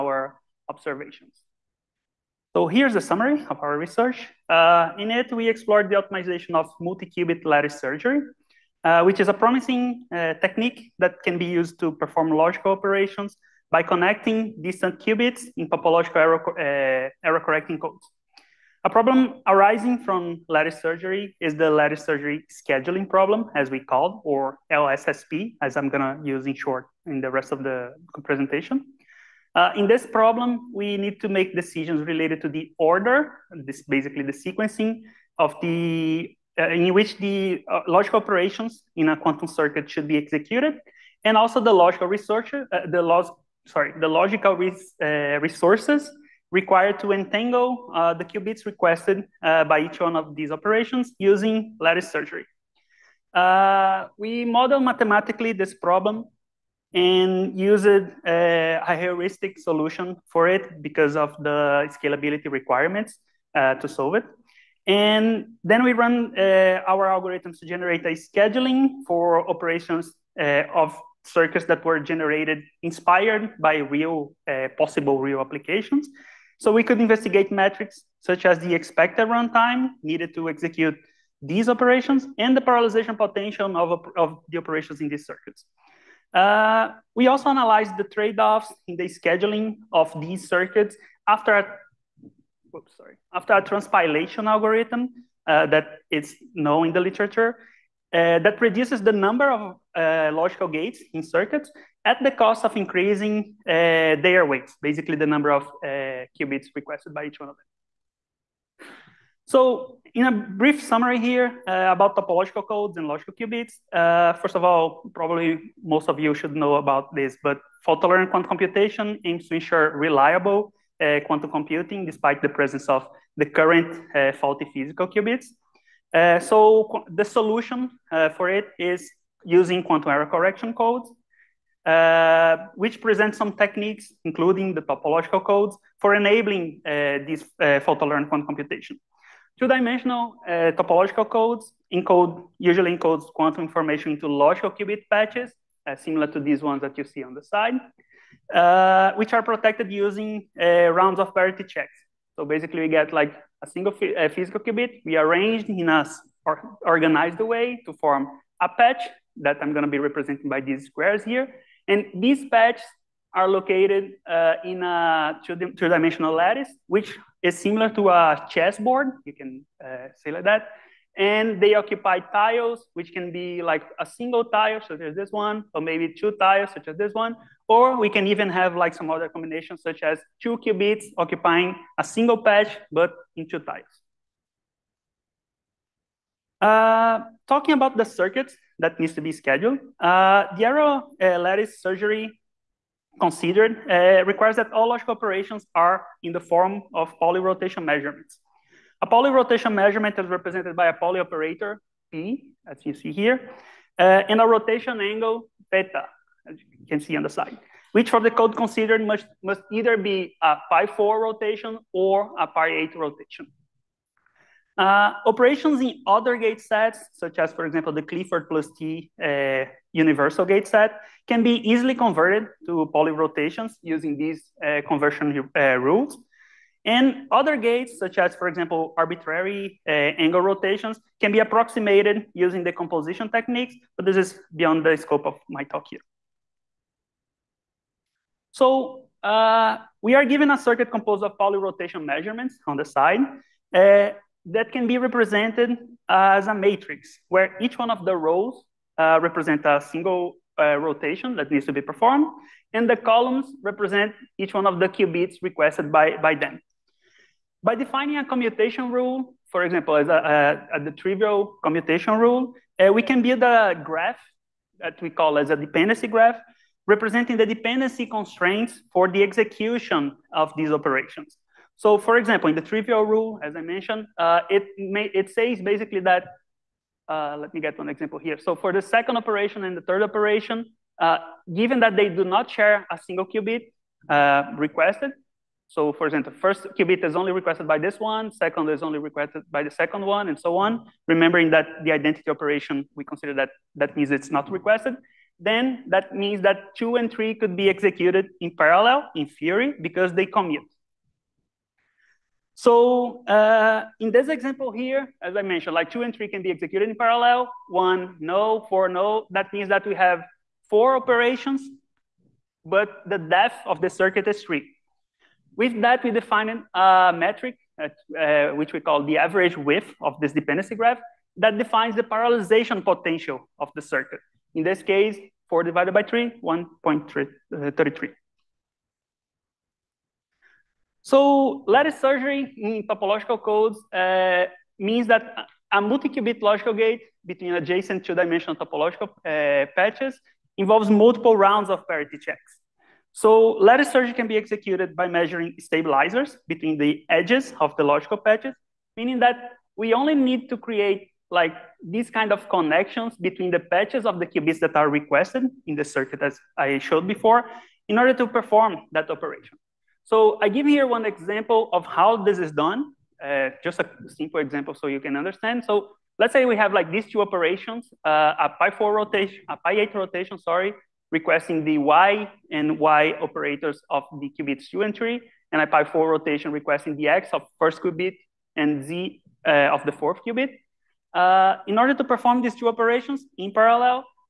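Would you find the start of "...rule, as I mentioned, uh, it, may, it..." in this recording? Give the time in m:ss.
4:33.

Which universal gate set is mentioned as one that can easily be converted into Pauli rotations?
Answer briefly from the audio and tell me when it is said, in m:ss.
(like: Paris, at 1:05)
Clifford plus T, at 3:38.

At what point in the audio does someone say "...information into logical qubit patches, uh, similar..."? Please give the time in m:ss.
2:23.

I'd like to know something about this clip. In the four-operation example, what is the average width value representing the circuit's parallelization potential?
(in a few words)
1.33.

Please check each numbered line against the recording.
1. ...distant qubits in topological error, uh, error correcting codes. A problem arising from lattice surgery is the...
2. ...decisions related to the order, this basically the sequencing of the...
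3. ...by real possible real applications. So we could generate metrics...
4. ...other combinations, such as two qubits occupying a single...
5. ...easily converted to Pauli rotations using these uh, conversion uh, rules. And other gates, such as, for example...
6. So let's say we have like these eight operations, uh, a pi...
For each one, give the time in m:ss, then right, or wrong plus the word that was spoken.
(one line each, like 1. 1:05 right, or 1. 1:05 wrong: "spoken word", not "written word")
1. 0:14 right
2. 0:31 right
3. 1:13 wrong: "investigate", not "generate"
4. 2:59 right
5. 3:41 right
6. 6:05 wrong: "two", not "eight".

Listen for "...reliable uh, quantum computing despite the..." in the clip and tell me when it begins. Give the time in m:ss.
1:59.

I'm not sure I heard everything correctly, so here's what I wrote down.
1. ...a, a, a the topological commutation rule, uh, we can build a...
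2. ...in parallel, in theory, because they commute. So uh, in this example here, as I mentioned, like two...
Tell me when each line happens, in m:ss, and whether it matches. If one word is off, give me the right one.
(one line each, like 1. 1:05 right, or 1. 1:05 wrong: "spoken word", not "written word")
1. 4:20 wrong: "trivial", not "topological"
2. 4:58 right.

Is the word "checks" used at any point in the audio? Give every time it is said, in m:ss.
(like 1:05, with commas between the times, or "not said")
2:31, 5:42.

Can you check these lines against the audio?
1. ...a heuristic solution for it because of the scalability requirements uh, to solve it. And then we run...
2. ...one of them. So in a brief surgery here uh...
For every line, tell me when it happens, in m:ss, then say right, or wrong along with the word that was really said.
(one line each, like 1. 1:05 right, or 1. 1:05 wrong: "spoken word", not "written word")
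1. 0:58 right
2. 1:47 wrong: "summary", not "surgery".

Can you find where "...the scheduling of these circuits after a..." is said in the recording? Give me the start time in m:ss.
1:28.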